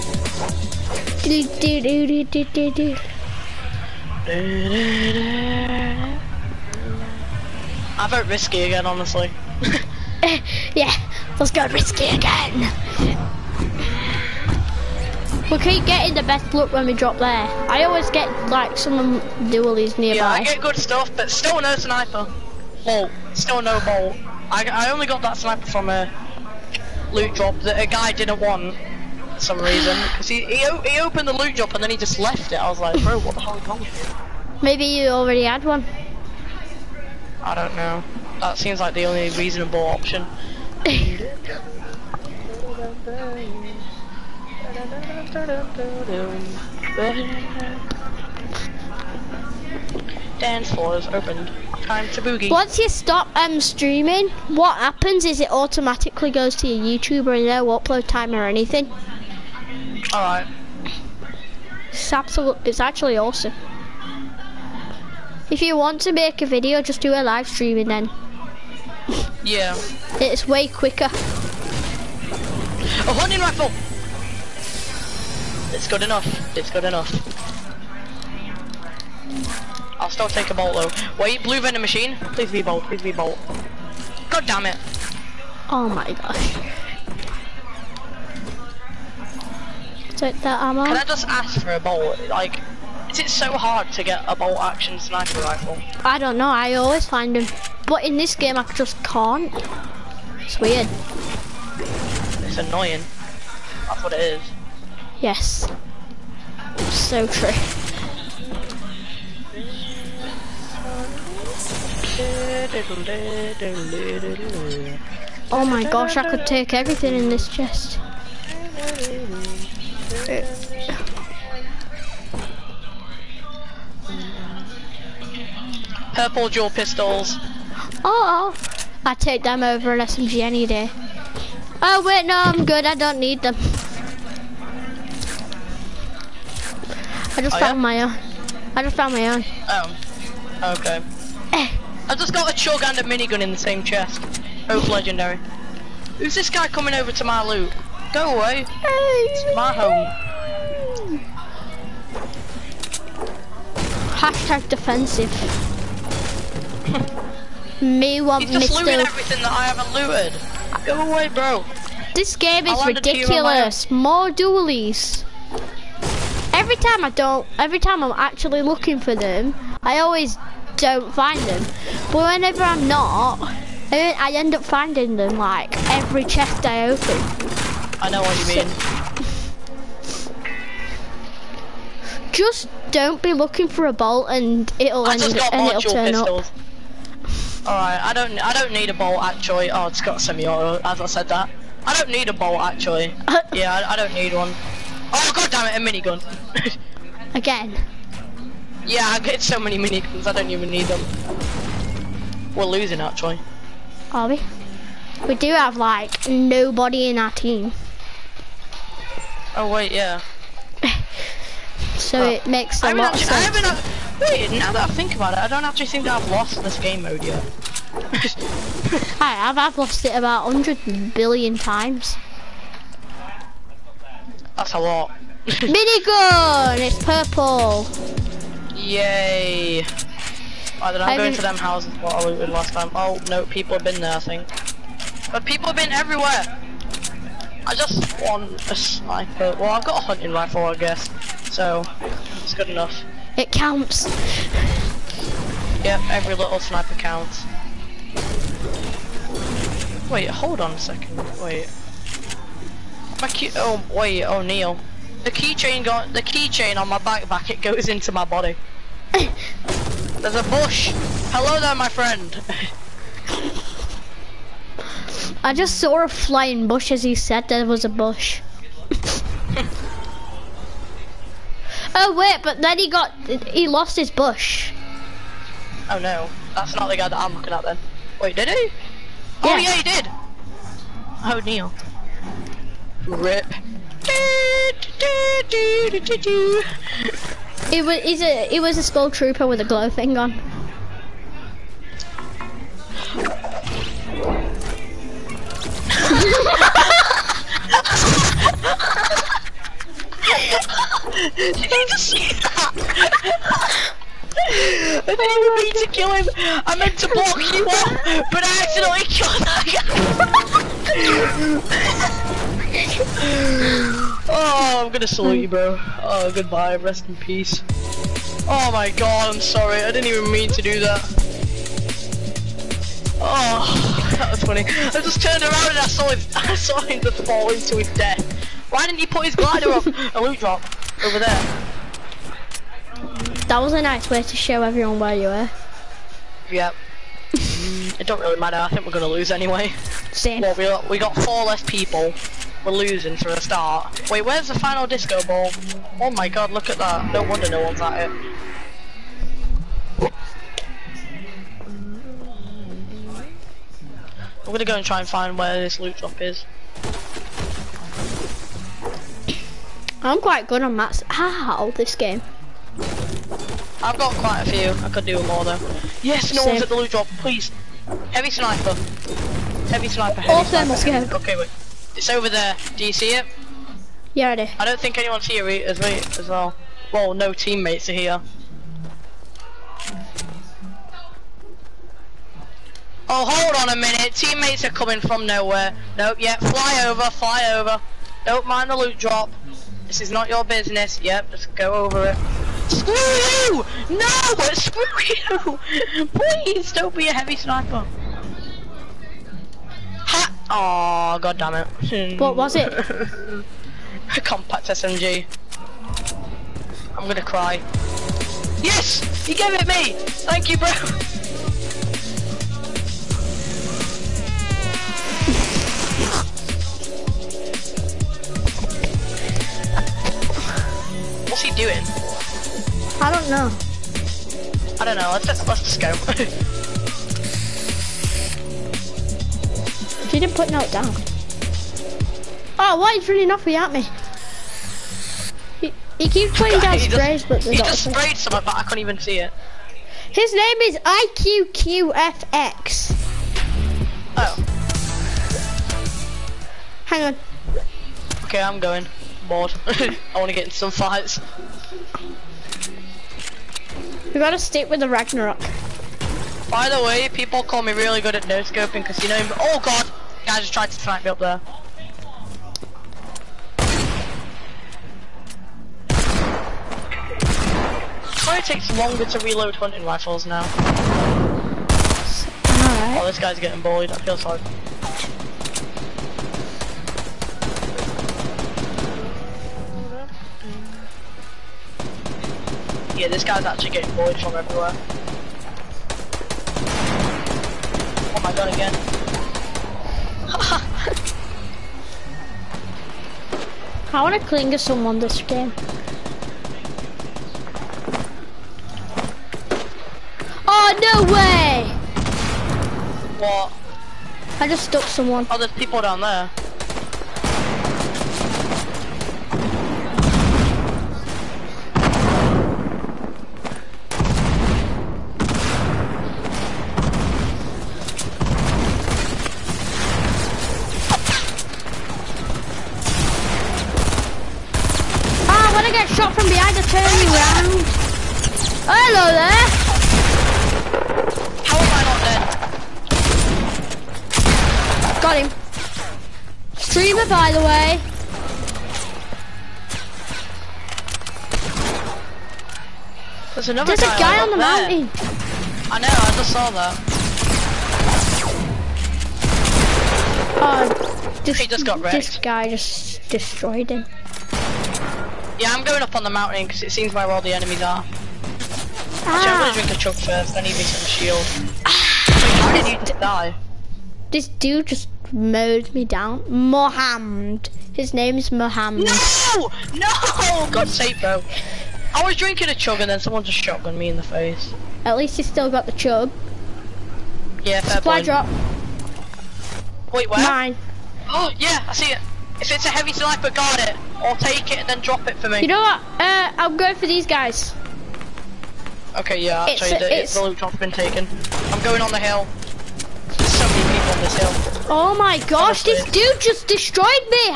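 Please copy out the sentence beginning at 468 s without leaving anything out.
Why it takes longer to reload hunting rifles now?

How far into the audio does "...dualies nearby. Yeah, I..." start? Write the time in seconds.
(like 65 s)
19 s.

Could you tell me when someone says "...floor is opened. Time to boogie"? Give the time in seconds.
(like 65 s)
50 s.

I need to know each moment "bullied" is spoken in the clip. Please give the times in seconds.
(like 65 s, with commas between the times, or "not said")
473 s, 483 s.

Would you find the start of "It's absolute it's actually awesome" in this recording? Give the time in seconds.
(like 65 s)
61 s.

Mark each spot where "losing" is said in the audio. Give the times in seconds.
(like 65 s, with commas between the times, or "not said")
202 s, 342 s.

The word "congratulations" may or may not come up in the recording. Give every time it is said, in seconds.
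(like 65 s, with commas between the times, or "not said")
not said.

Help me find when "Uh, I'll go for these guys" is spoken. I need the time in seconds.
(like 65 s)
586 s.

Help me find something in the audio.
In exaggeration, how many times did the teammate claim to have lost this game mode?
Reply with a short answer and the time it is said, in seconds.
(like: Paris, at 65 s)
100 billion, at 220 s.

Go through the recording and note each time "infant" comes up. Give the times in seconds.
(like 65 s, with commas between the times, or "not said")
not said.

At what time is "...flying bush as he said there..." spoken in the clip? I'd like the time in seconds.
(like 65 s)
266 s.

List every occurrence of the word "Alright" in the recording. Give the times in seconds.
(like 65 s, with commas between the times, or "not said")
60 s, 187 s, 472 s.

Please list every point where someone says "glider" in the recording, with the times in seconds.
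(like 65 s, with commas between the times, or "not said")
329 s.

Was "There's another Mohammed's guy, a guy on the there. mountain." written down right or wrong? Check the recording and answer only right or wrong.
wrong.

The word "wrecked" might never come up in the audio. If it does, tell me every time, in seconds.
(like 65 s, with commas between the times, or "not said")
551 s.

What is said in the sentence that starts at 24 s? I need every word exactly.
I, I only got that sniper from a loot drop that a guy didn't want for some reason.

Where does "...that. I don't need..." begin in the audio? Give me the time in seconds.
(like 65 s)
191 s.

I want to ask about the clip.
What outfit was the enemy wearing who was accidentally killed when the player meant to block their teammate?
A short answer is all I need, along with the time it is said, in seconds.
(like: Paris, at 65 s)
Skull trooper, at 288 s.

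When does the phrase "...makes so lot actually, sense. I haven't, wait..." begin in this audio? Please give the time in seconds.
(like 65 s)
212 s.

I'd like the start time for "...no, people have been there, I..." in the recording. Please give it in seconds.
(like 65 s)
233 s.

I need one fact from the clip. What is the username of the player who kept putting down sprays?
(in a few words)
IQQFX.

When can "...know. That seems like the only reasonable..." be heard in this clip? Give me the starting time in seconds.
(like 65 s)
37 s.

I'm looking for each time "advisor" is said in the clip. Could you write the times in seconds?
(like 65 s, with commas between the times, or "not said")
not said.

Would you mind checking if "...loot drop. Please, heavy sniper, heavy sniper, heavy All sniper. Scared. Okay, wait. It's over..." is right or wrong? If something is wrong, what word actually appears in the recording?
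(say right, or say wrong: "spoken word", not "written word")
right.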